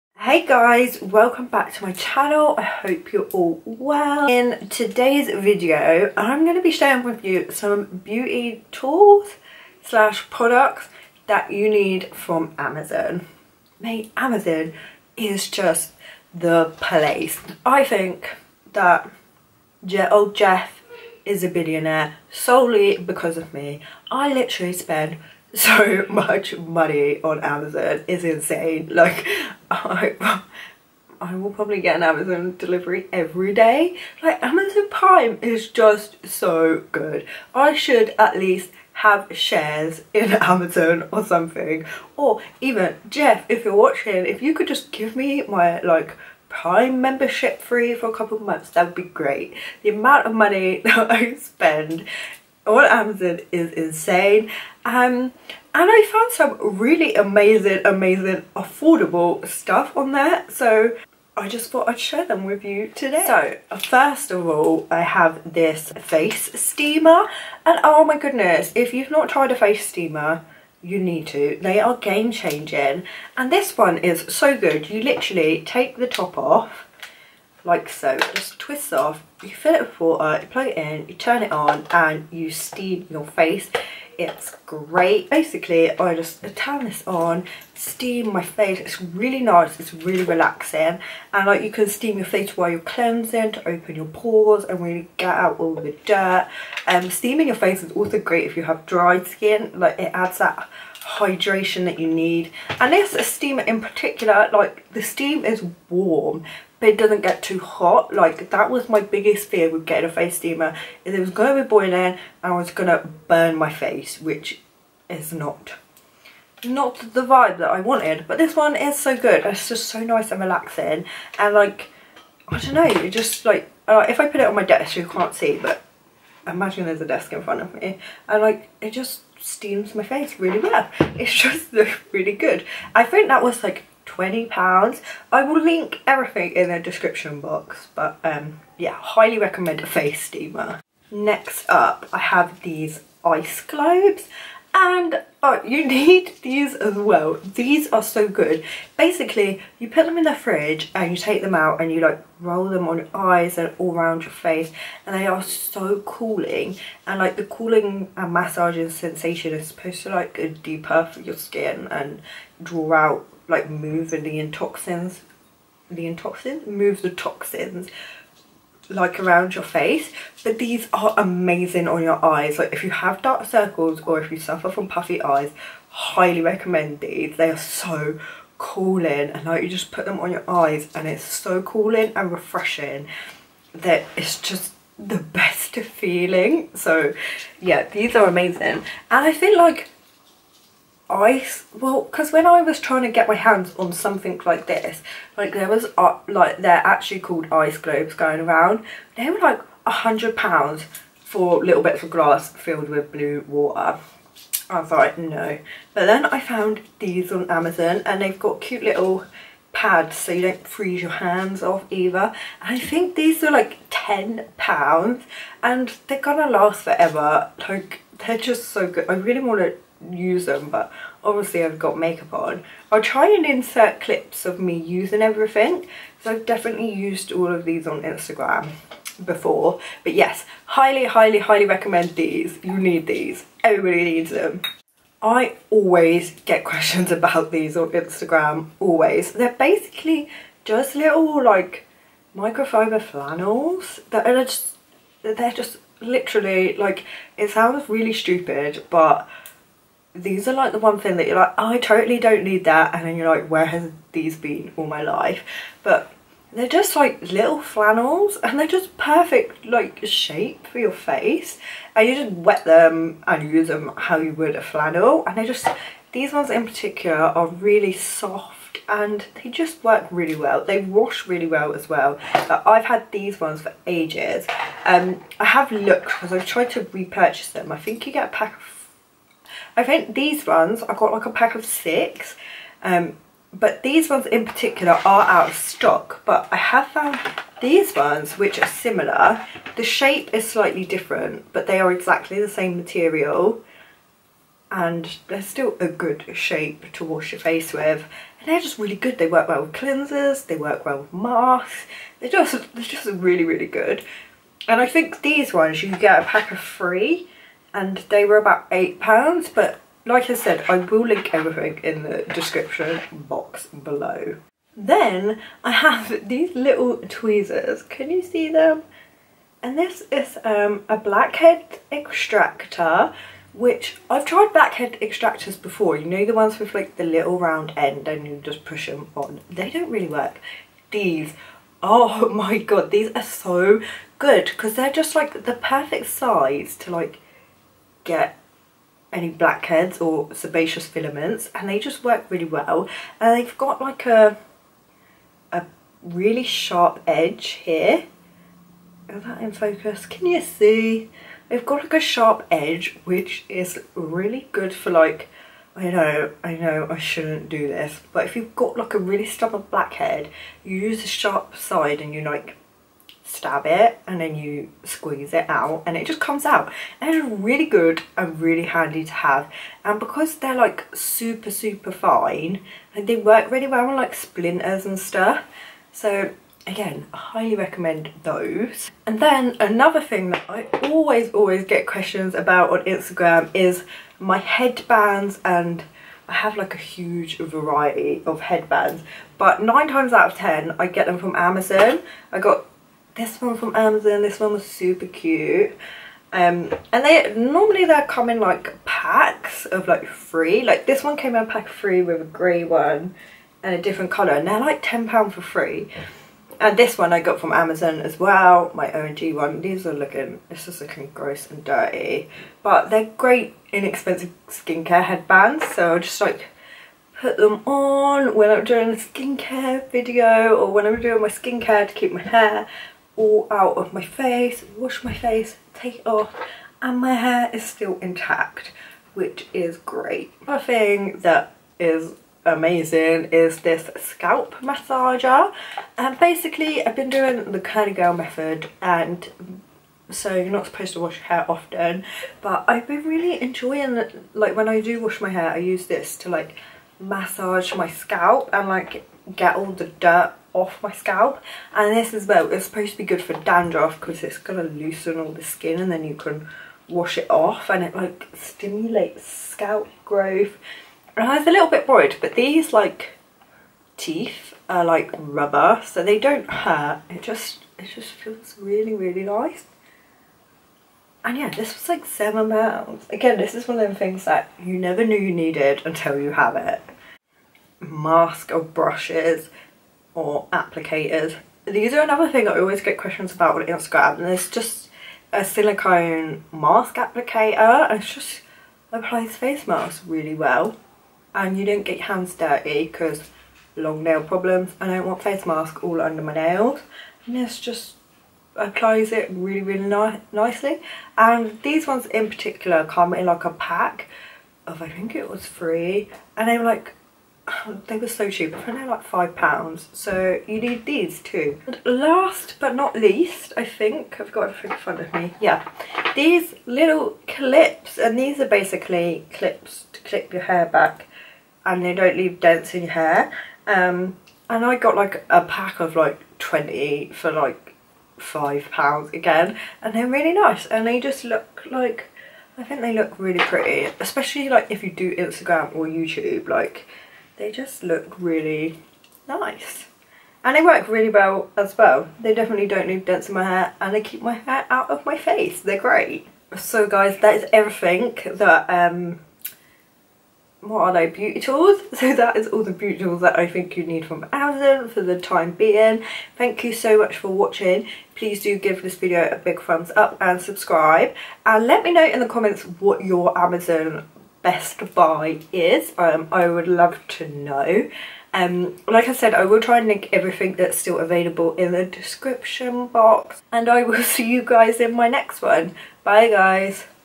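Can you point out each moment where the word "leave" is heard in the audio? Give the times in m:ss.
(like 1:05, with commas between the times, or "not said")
8:42, 9:02.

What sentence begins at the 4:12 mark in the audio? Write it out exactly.
And then you're like, where has these been all my life?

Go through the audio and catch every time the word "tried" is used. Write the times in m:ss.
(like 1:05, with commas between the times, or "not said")
1:09, 4:36, 5:24.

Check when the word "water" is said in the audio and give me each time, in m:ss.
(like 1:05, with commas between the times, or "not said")
1:19, 3:23.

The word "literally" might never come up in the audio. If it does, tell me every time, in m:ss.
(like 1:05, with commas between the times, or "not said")
0:24, 1:15, 4:05.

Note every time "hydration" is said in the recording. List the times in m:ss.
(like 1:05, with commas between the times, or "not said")
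1:41.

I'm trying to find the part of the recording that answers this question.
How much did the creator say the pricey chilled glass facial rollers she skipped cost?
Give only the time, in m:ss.
3:19.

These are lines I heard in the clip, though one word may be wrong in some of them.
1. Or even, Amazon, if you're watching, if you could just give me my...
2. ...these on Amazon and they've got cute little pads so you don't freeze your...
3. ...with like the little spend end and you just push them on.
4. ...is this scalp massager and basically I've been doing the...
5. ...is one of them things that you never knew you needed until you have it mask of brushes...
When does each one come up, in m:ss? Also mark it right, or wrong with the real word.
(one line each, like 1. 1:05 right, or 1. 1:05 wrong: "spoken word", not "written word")
1. 0:42 wrong: "Jeff", not "Amazon"
2. 3:26 right
3. 5:26 wrong: "round", not "spend"
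4. 7:13 right
5. 7:53 right.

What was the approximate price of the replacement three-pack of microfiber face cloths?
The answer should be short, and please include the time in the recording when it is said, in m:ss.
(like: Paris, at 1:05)
£8, at 5:08.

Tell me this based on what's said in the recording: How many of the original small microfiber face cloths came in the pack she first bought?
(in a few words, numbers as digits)
6.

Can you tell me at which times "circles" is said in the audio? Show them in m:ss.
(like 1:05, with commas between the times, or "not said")
2:53.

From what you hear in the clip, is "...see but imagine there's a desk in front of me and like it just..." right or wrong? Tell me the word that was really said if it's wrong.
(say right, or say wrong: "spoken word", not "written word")
right.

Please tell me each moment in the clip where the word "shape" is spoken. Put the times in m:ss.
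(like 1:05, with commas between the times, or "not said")
4:20, 4:49, 4:56.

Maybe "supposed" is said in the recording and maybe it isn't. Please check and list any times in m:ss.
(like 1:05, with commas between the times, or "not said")
2:39, 7:20, 7:32.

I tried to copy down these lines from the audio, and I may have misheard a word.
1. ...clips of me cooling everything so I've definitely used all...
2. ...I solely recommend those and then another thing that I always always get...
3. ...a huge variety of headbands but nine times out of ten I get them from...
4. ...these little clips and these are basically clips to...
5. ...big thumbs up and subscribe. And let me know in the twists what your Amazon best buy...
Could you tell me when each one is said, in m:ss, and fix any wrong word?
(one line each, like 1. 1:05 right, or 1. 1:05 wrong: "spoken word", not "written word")
1. 3:44 wrong: "using", not "cooling"
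2. 6:17 wrong: "highly", not "solely"
3. 6:26 right
4. 8:36 right
5. 9:19 wrong: "comments", not "twists".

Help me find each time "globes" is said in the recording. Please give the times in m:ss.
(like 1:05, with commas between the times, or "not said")
2:23, 3:17.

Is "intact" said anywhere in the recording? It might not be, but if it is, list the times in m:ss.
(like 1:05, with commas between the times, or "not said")
7:08.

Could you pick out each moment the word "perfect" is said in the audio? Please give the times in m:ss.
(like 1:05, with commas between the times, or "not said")
4:18, 5:35.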